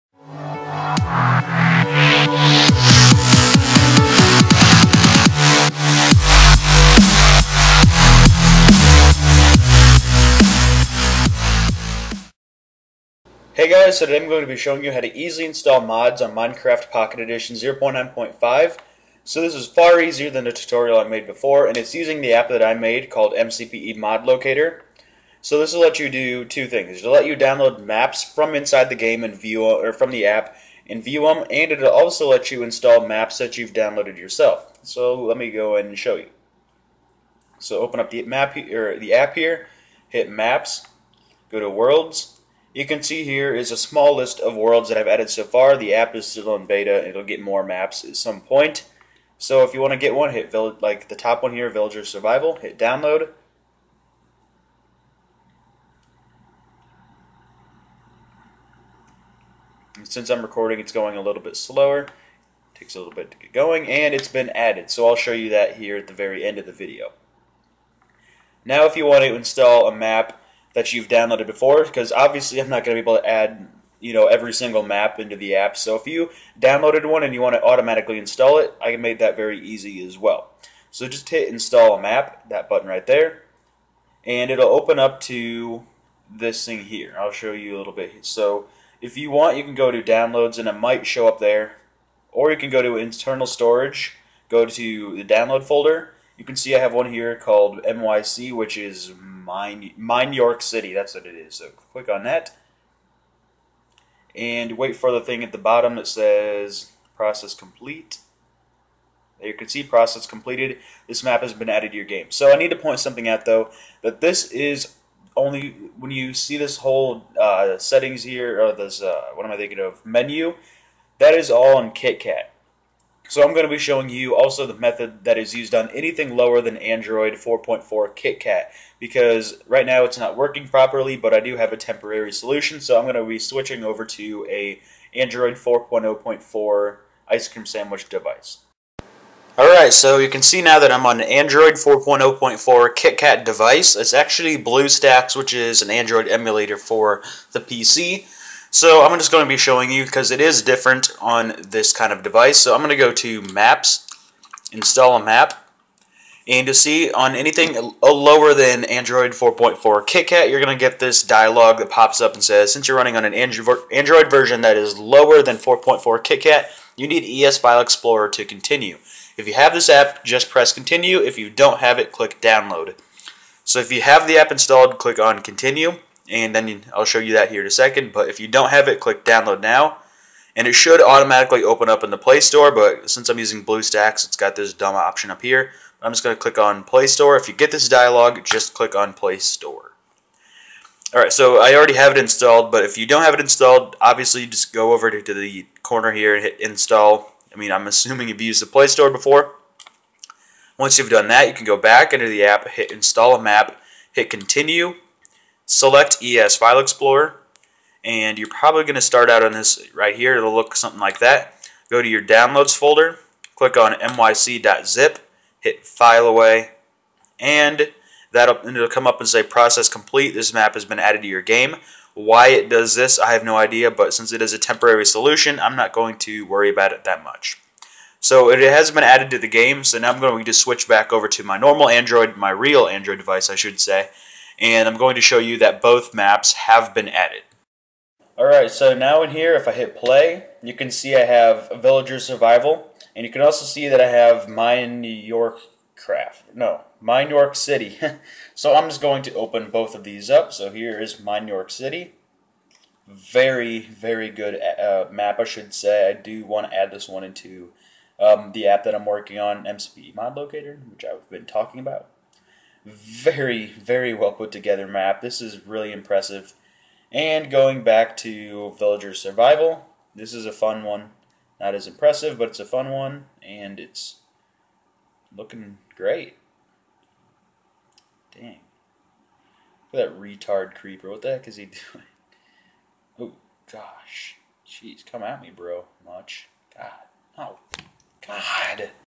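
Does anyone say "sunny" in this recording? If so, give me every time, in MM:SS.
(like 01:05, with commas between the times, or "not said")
not said.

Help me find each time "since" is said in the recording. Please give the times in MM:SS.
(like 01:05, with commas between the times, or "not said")
01:00, 02:42, 03:03, 03:44.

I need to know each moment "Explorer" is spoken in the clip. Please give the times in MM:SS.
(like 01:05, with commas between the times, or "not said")
02:47, 03:26.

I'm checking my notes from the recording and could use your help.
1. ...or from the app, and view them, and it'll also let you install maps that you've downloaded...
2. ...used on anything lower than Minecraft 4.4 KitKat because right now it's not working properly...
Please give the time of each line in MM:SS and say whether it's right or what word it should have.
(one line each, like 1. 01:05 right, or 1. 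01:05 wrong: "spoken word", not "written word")
1. 00:29 right
2. 02:05 wrong: "Android", not "Minecraft".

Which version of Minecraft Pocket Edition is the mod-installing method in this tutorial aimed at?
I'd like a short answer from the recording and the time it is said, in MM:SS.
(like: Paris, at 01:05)
0.9.5, at 00:17.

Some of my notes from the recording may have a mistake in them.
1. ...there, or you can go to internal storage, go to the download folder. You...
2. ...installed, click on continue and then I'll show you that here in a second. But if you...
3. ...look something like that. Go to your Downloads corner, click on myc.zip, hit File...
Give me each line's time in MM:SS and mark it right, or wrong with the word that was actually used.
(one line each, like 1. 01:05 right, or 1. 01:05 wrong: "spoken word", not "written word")
1. 01:31 right
2. 02:54 right
3. 03:30 wrong: "folder", not "corner".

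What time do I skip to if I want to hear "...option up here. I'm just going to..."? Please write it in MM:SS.
03:04.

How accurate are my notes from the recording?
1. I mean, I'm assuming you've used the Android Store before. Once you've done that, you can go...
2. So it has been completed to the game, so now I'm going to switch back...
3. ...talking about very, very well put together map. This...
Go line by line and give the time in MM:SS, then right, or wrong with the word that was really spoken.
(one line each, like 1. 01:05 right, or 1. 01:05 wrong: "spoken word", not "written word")
1. 03:17 wrong: "Play", not "Android"
2. 03:48 wrong: "added", not "completed"
3. 04:21 right.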